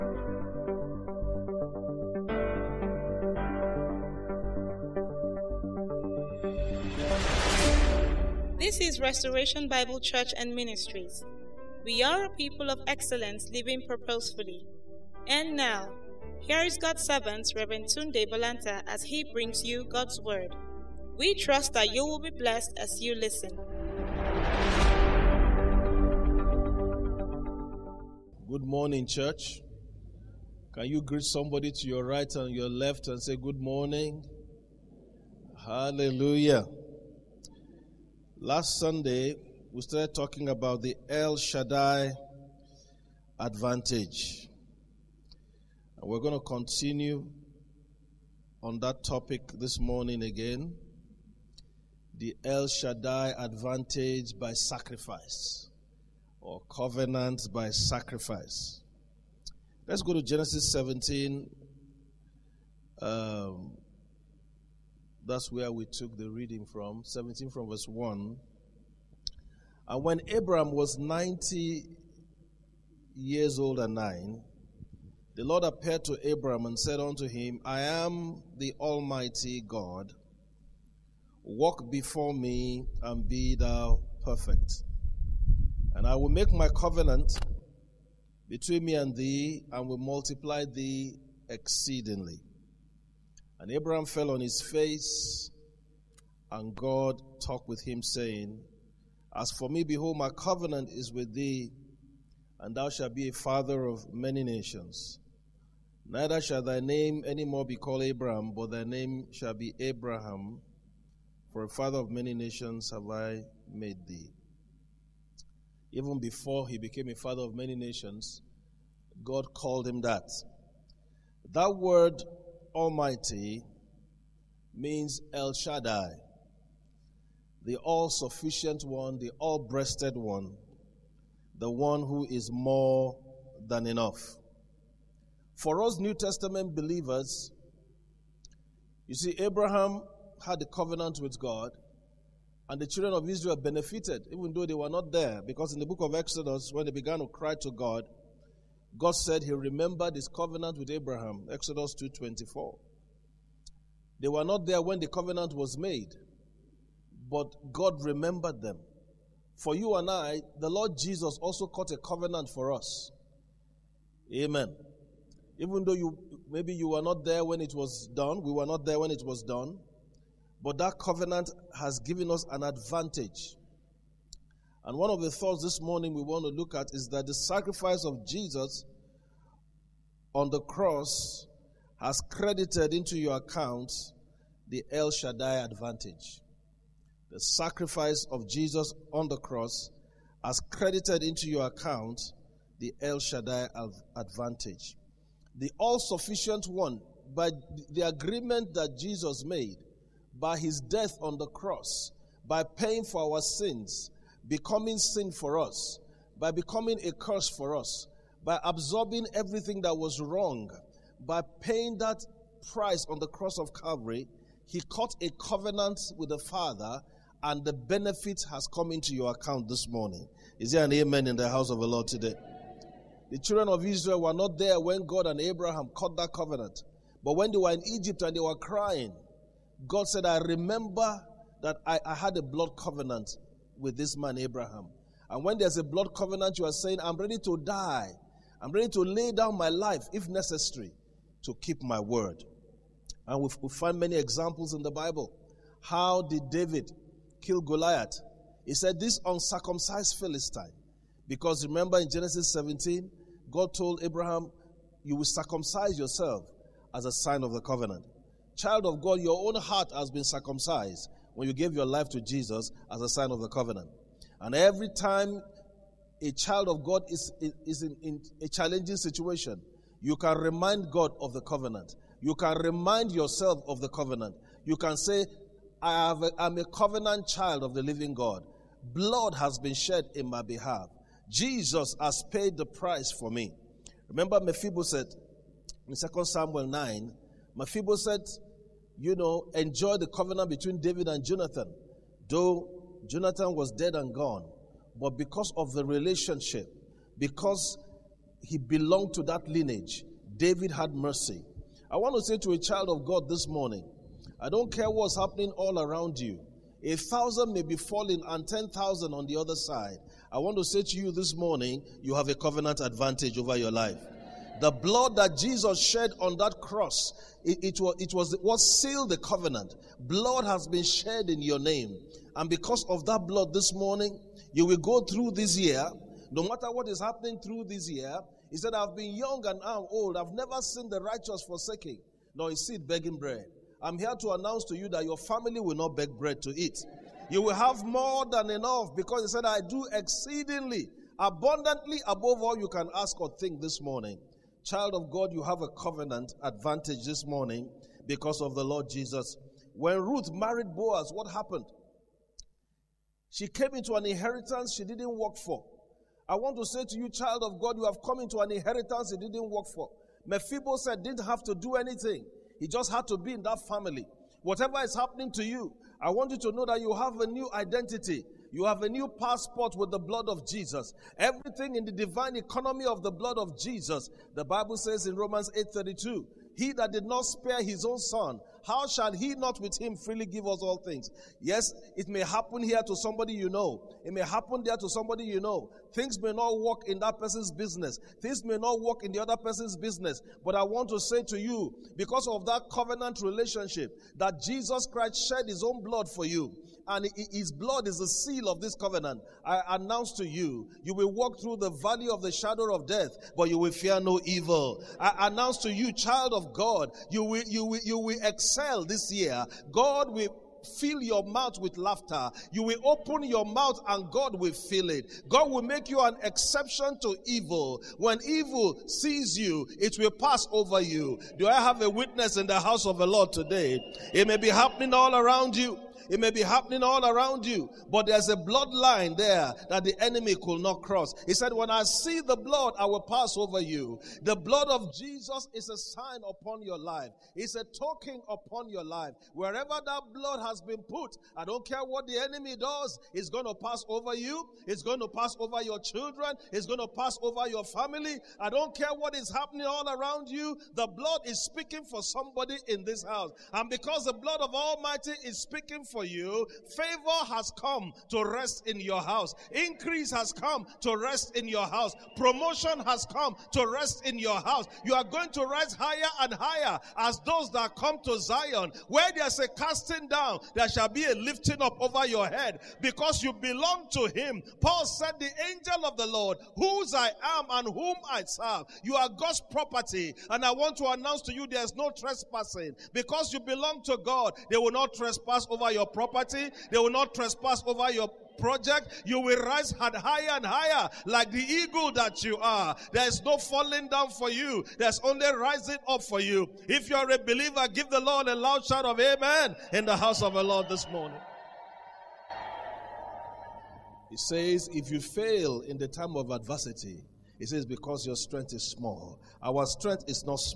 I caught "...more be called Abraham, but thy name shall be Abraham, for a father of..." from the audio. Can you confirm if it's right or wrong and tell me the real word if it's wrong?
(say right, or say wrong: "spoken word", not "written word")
right.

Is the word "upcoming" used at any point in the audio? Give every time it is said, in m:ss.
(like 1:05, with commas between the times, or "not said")
not said.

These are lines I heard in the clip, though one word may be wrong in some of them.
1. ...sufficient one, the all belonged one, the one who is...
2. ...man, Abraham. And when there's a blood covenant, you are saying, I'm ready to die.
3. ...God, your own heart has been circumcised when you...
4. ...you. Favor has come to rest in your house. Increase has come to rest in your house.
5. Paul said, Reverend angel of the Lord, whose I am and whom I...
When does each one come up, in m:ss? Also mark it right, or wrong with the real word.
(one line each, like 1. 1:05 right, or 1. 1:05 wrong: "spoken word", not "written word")
1. 2:08 wrong: "breasted", not "belonged"
2. 3:54 right
3. 4:18 right
4. 7:36 right
5. 7:54 wrong: "The", not "Reverend".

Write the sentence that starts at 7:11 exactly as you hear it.
He said, When I see the blood, I will pass over you.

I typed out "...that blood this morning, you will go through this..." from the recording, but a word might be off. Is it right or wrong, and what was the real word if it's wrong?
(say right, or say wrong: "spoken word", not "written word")
right.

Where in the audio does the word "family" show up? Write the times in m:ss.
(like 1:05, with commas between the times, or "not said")
5:35, 6:03, 7:27.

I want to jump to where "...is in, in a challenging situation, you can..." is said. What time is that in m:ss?
4:27.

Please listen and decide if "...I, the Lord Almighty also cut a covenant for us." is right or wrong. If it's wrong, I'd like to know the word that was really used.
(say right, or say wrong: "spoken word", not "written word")
wrong: "Jesus", not "Almighty".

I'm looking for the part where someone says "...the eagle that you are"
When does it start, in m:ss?
8:11.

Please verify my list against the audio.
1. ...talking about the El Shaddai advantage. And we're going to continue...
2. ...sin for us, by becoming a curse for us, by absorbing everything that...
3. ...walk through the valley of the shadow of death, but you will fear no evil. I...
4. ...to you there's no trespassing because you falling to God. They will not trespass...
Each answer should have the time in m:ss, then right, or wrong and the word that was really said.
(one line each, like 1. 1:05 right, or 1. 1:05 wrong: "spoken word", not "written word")
1. 0:40 right
2. 3:24 right
3. 6:41 right
4. 8:01 wrong: "belong", not "falling".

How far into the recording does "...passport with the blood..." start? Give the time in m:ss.
6:09.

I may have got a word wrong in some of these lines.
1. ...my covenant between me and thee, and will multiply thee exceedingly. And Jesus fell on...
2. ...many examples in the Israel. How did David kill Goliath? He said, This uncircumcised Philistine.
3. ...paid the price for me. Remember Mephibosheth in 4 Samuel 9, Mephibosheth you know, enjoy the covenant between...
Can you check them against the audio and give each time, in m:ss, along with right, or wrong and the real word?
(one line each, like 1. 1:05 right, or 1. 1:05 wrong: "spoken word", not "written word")
1. 1:26 wrong: "Abraham", not "Jesus"
2. 4:03 wrong: "Bible", not "Israel"
3. 4:42 wrong: "2", not "4".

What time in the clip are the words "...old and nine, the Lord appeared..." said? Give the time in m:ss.
1:13.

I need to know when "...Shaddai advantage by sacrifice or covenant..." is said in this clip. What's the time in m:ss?
0:52.